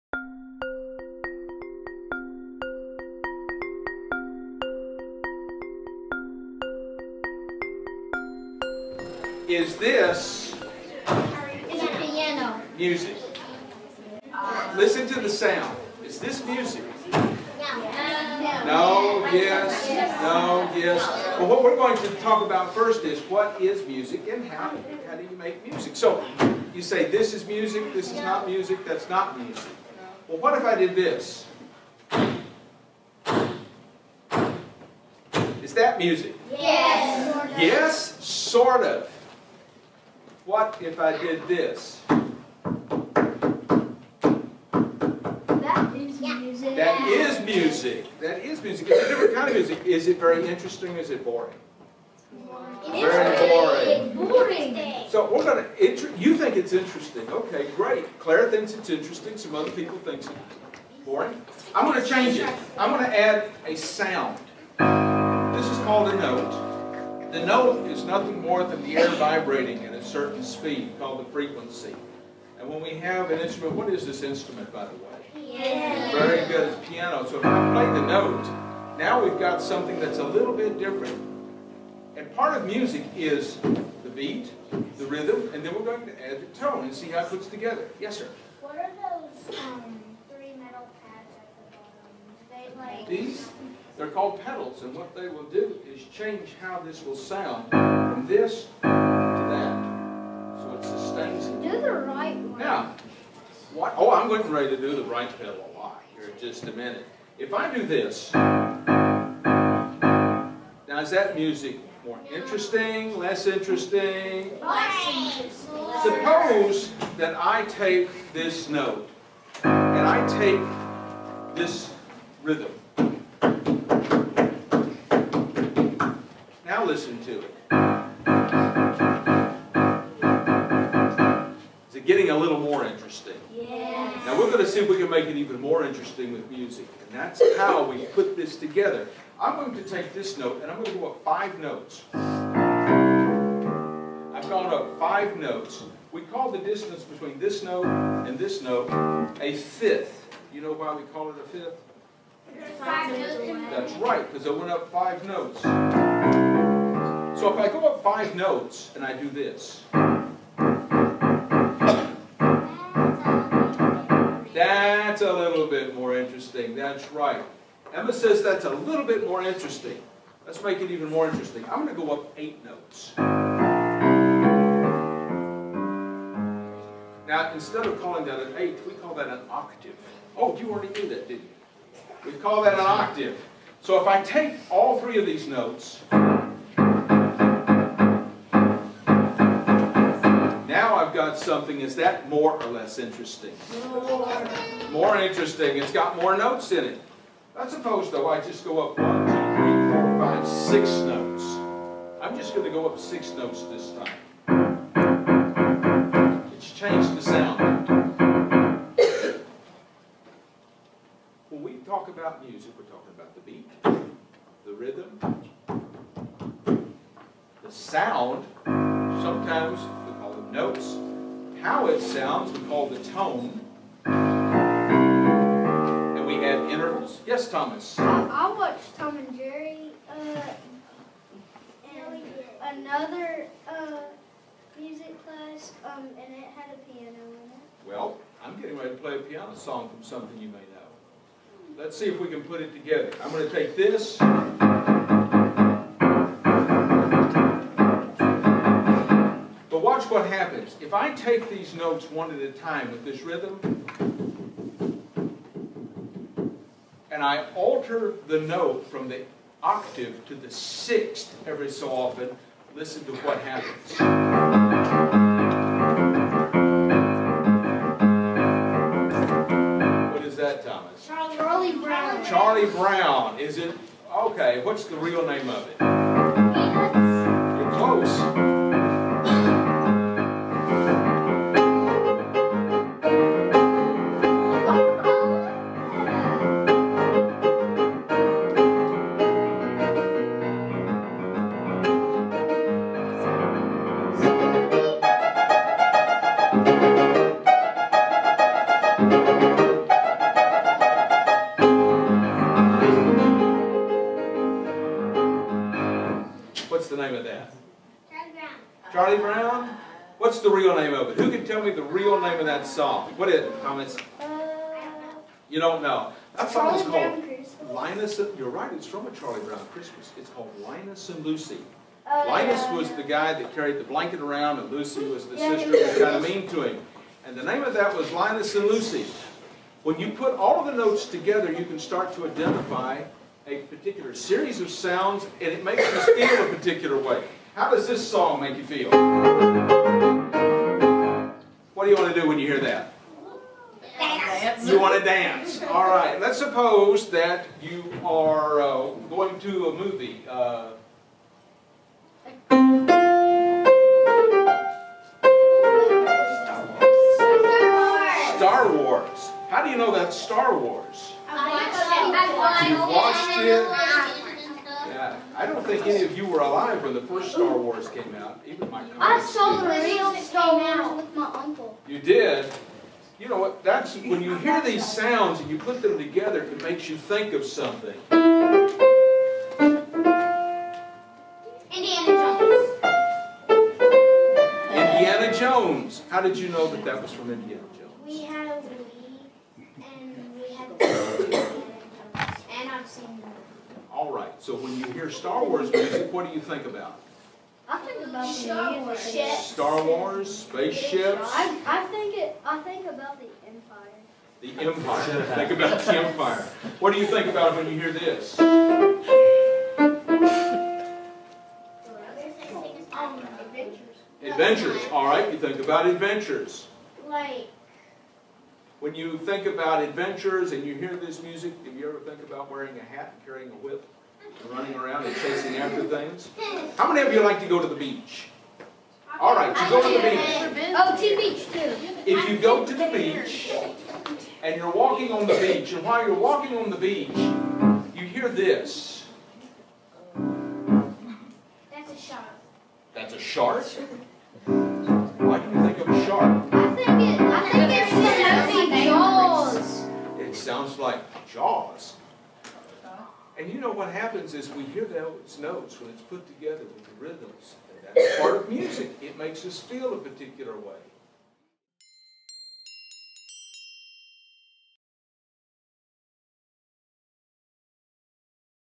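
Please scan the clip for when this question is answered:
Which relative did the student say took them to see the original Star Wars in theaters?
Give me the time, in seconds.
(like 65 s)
371 s.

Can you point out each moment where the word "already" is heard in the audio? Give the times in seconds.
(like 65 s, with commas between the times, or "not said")
180 s.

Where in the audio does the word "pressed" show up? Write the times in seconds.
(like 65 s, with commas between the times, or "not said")
not said.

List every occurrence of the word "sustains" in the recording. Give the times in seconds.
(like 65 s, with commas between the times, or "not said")
100 s.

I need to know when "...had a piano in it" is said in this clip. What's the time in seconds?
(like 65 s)
236 s.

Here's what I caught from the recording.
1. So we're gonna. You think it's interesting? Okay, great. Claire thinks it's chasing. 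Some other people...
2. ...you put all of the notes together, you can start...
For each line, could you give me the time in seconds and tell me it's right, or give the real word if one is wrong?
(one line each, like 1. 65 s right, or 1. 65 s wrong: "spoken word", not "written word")
1. 55 s wrong: "interesting", not "chasing"
2. 329 s right.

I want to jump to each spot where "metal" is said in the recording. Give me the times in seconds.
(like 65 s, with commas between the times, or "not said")
90 s.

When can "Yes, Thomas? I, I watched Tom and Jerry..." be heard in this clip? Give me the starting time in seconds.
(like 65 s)
227 s.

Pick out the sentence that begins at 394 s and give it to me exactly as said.
So when you hear Star Wars music, what do you think about?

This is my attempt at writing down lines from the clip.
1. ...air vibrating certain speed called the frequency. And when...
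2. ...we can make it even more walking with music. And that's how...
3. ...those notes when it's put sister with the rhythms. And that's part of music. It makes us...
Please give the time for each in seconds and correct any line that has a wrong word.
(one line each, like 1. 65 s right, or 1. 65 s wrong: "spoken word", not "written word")
1. 68 s right
2. 134 s wrong: "interesting", not "walking"
3. 454 s wrong: "together", not "sister".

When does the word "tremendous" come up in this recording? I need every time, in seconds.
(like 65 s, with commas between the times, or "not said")
not said.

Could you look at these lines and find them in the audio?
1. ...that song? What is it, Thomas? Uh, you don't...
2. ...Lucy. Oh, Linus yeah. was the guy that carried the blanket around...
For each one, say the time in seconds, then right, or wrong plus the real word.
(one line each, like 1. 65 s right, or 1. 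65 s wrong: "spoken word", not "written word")
1. 312 s right
2. 321 s right.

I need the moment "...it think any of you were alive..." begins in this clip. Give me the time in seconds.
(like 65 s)
363 s.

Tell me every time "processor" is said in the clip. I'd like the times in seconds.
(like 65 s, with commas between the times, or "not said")
not said.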